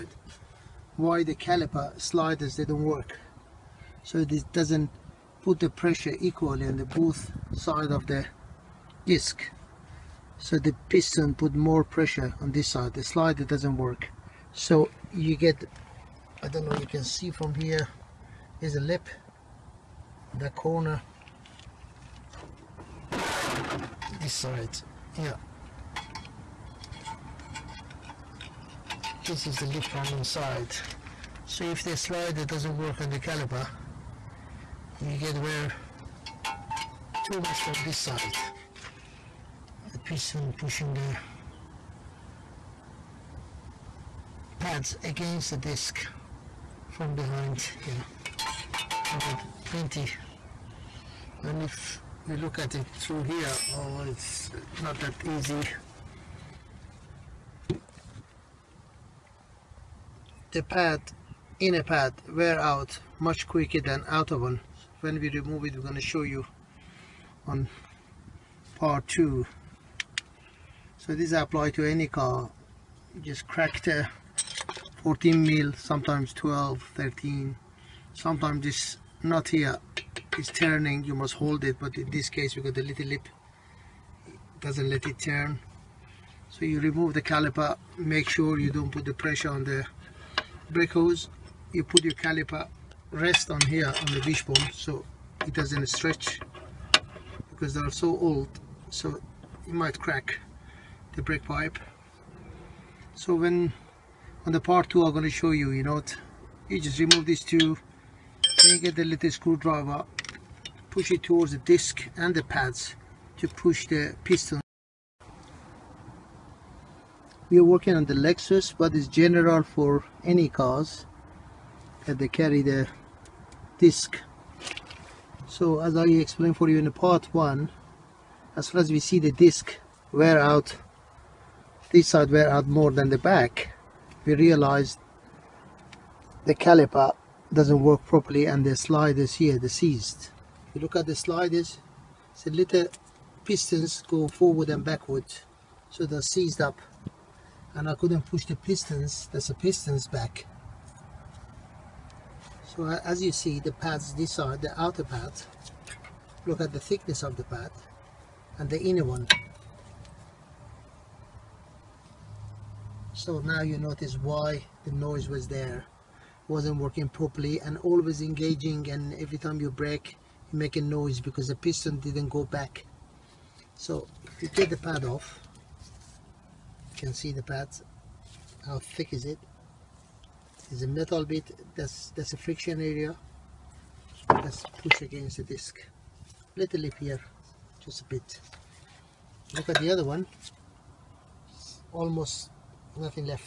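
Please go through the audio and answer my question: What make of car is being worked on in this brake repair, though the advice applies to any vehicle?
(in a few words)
Lexus.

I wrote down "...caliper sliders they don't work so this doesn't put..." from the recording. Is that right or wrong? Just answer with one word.
right.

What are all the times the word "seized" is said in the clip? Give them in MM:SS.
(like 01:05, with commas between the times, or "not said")
02:19, 02:26.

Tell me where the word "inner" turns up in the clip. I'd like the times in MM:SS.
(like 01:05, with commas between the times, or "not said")
01:01, 02:38.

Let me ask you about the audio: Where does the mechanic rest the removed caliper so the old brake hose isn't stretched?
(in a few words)
On the wishbone.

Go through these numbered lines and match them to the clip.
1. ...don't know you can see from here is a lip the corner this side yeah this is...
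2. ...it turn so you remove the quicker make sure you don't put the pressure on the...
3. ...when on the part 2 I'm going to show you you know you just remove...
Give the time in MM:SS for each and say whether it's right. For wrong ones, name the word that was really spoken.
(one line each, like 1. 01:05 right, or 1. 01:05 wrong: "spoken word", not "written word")
1. 00:16 right
2. 01:25 wrong: "caliper", not "quicker"
3. 01:43 right.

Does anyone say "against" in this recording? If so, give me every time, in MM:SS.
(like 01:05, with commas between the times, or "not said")
00:45, 03:05.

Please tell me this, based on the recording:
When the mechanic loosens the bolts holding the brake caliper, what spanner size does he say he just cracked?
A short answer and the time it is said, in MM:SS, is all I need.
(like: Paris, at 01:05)
14 mm, at 01:15.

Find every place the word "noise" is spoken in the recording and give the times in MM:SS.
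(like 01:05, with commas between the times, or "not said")
02:44, 02:50.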